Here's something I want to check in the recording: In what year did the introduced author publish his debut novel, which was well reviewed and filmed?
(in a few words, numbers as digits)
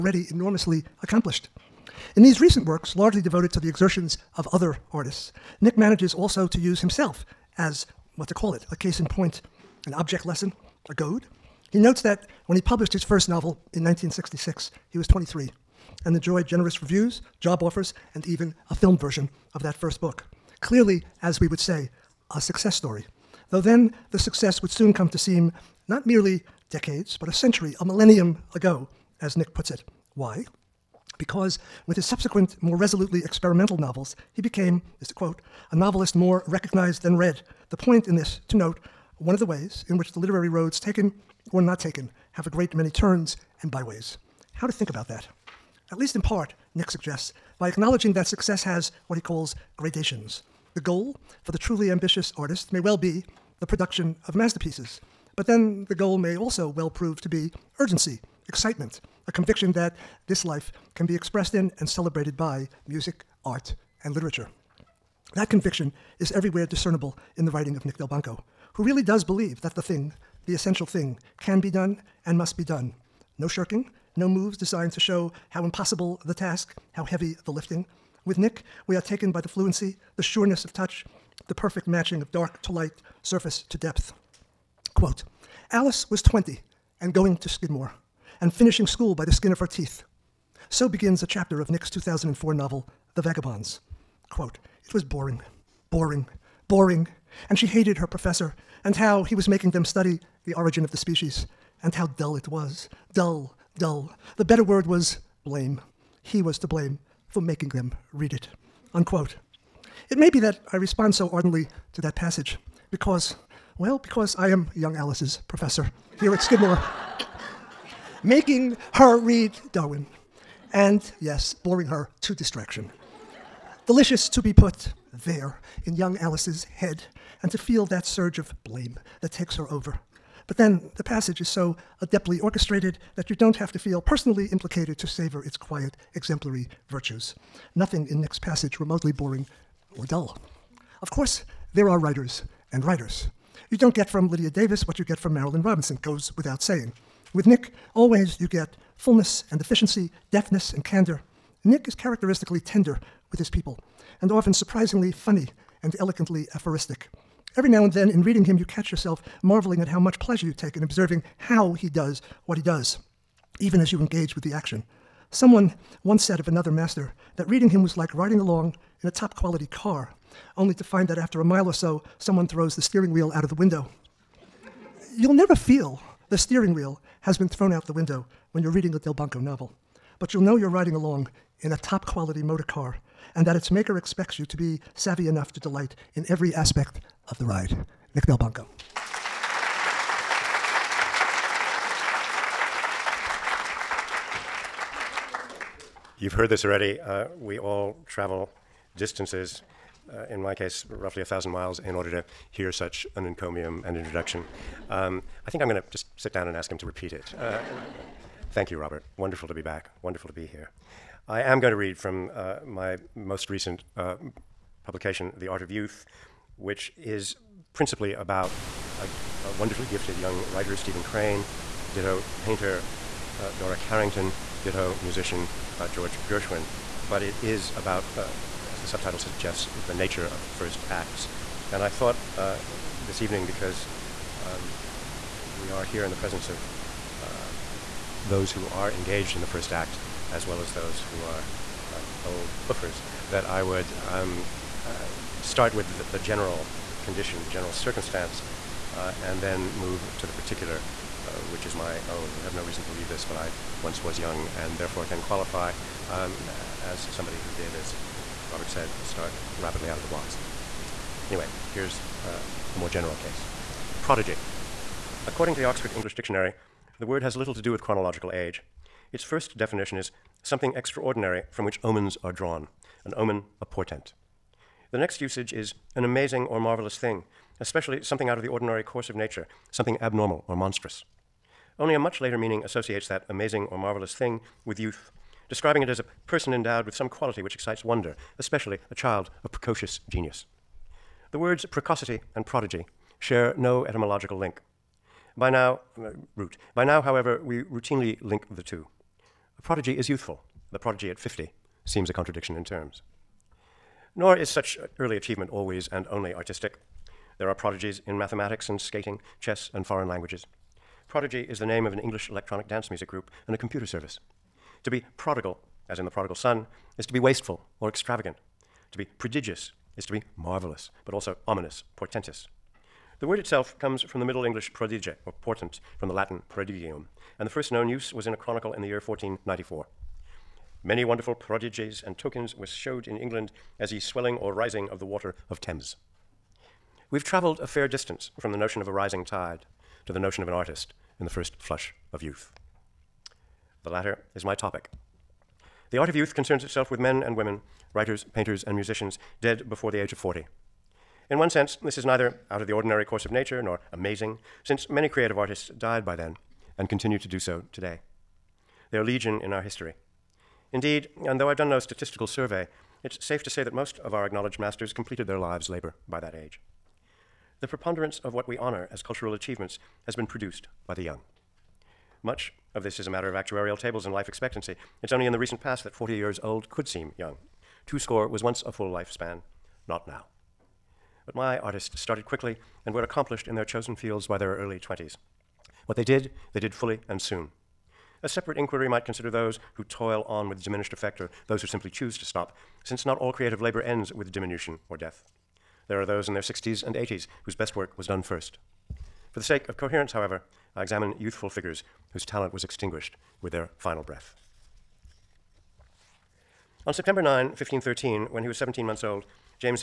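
1966.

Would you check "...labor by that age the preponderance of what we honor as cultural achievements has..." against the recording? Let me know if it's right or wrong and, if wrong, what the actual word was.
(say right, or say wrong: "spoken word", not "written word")
right.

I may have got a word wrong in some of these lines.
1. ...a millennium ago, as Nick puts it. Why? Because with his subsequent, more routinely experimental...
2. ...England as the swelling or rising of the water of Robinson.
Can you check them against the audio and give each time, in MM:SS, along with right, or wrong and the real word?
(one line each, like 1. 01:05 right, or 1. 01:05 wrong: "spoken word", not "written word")
1. 00:27 wrong: "resolutely", not "routinely"
2. 05:33 wrong: "Thames", not "Robinson".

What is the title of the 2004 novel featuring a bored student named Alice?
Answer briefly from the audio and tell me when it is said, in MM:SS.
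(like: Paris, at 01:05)
The Vagabonds, at 01:33.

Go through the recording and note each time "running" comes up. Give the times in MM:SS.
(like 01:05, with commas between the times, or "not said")
not said.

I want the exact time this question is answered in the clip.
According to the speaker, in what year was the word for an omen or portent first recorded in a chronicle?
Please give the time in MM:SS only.
05:29.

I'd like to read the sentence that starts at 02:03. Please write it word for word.
Delicious to be put there in young Alice's head and to feel that surge of blame that takes her over.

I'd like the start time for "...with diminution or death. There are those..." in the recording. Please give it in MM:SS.
06:34.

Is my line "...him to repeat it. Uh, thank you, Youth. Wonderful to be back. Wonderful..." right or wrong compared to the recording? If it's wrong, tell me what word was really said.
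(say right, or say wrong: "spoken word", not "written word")
wrong: "Robert", not "Youth".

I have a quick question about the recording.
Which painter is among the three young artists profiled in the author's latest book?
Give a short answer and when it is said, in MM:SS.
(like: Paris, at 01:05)
Dora Carrington, at 03:43.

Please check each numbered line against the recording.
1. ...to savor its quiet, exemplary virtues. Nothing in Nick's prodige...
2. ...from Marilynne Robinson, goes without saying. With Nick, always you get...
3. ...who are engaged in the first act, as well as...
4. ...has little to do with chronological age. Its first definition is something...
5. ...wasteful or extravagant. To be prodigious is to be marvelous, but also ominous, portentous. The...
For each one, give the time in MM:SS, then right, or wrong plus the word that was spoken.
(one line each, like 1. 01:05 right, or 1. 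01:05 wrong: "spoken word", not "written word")
1. 02:14 wrong: "passage", not "prodige"
2. 02:25 right
3. 03:58 right
4. 04:27 right
5. 05:17 right.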